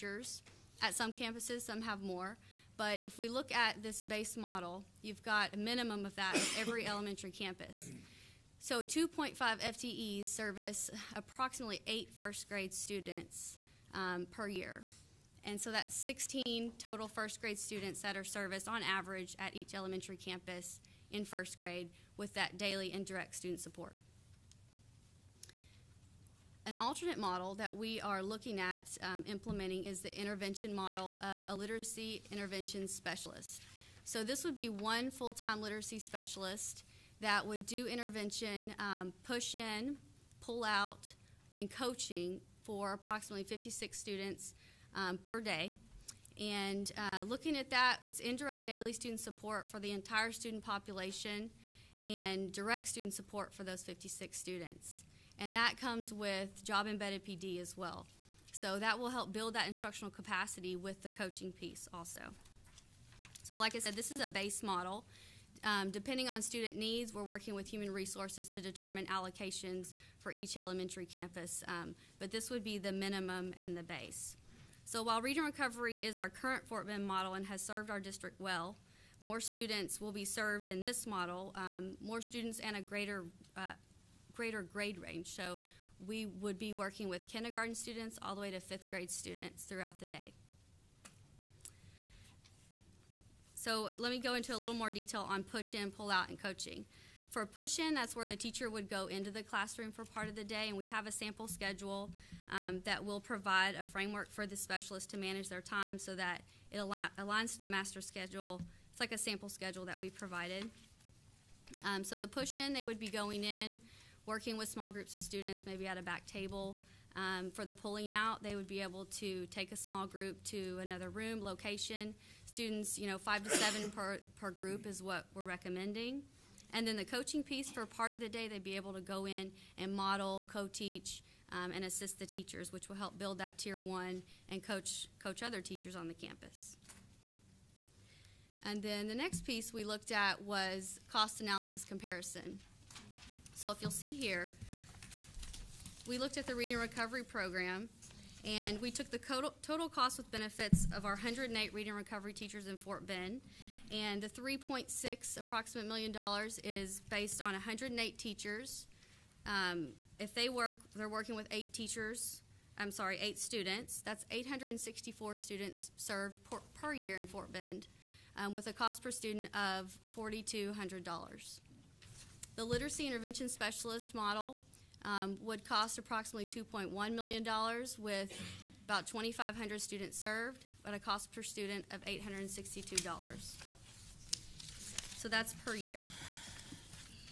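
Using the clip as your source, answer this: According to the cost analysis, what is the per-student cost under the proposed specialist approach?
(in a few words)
$862.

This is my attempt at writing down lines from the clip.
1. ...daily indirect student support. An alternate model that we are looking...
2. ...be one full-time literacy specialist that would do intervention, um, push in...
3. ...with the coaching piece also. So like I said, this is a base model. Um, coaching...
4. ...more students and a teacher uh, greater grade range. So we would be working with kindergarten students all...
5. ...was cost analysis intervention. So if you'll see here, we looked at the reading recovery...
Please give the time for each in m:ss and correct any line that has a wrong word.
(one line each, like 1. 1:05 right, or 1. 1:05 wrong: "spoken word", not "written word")
1. 0:22 right
2. 0:34 right
3. 1:00 wrong: "depending", not "coaching"
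4. 1:22 wrong: "greater", not "teacher"
5. 2:20 wrong: "comparison", not "intervention".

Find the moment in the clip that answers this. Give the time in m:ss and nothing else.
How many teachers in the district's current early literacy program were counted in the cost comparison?
2:31.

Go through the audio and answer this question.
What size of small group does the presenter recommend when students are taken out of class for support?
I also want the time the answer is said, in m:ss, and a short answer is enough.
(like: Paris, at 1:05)
5 to 7, at 2:03.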